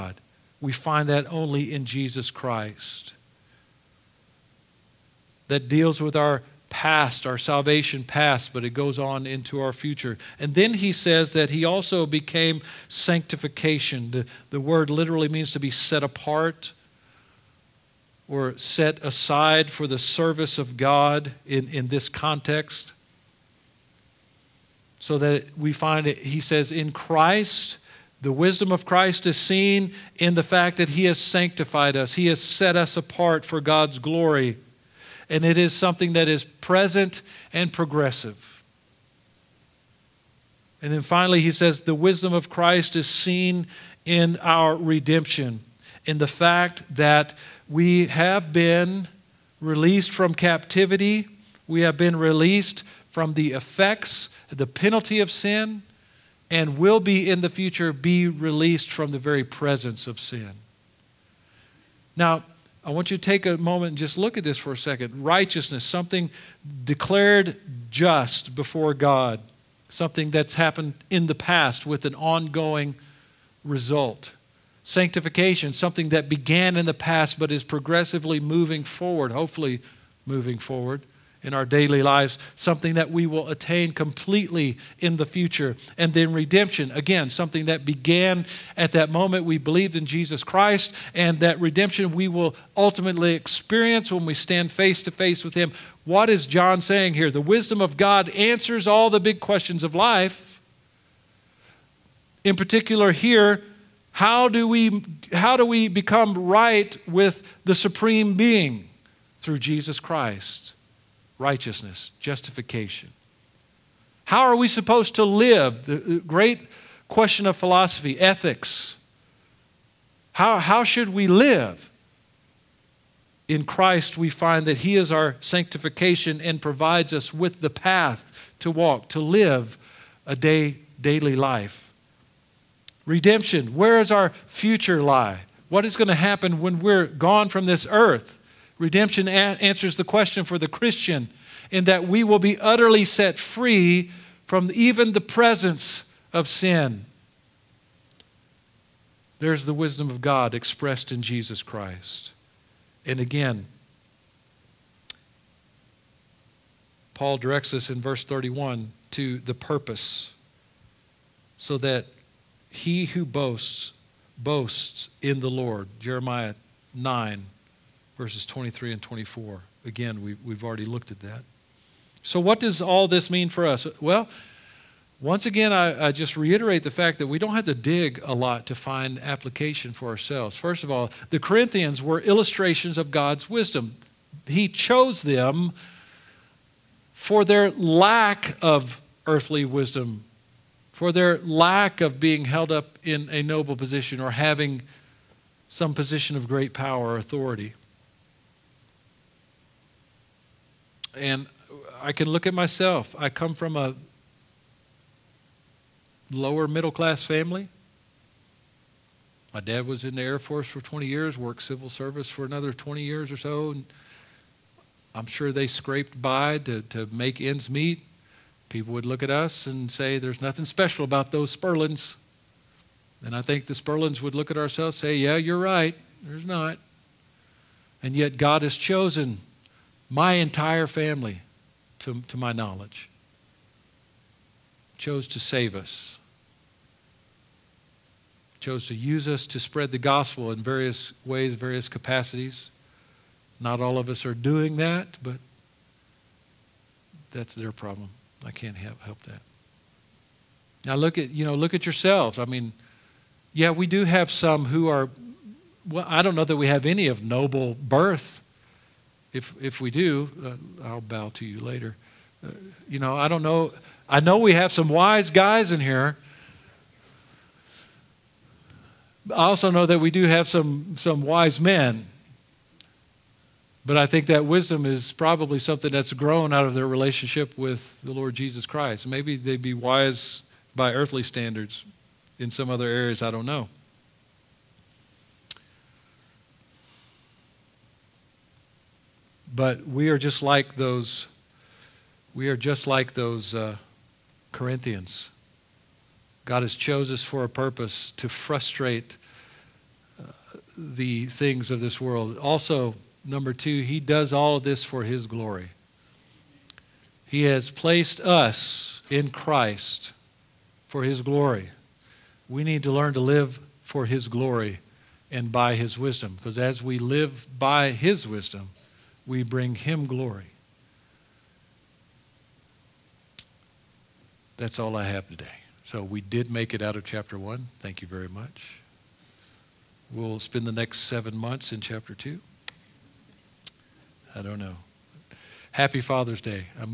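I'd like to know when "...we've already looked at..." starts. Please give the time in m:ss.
2:50.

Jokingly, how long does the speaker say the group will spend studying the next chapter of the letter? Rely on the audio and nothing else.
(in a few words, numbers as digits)
7 months.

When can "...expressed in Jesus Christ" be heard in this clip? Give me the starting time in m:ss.
2:30.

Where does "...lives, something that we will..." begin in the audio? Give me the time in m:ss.
1:22.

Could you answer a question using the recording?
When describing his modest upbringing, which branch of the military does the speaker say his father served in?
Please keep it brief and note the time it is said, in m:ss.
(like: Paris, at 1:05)
Air Force, at 3:30.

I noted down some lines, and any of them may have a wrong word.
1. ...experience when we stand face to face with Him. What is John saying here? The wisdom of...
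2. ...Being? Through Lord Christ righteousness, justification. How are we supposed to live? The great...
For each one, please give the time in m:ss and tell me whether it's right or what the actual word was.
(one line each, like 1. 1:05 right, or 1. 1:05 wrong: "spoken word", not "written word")
1. 1:33 right
2. 1:48 wrong: "Jesus", not "Lord".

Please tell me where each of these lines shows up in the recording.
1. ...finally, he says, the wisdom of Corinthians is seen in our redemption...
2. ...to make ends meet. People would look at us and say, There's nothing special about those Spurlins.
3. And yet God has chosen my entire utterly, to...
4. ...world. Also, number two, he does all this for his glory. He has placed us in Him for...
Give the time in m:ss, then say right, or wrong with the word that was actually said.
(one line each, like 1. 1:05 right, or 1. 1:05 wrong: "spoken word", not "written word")
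1. 0:40 wrong: "Christ", not "Corinthians"
2. 3:36 right
3. 3:48 wrong: "family", not "utterly"
4. 5:01 wrong: "Christ", not "Him".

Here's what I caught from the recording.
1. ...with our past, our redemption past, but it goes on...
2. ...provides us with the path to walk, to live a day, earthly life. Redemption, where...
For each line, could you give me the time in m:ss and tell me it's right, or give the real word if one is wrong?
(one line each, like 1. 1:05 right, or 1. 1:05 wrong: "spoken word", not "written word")
1. 0:05 wrong: "salvation", not "redemption"
2. 2:06 wrong: "daily", not "earthly".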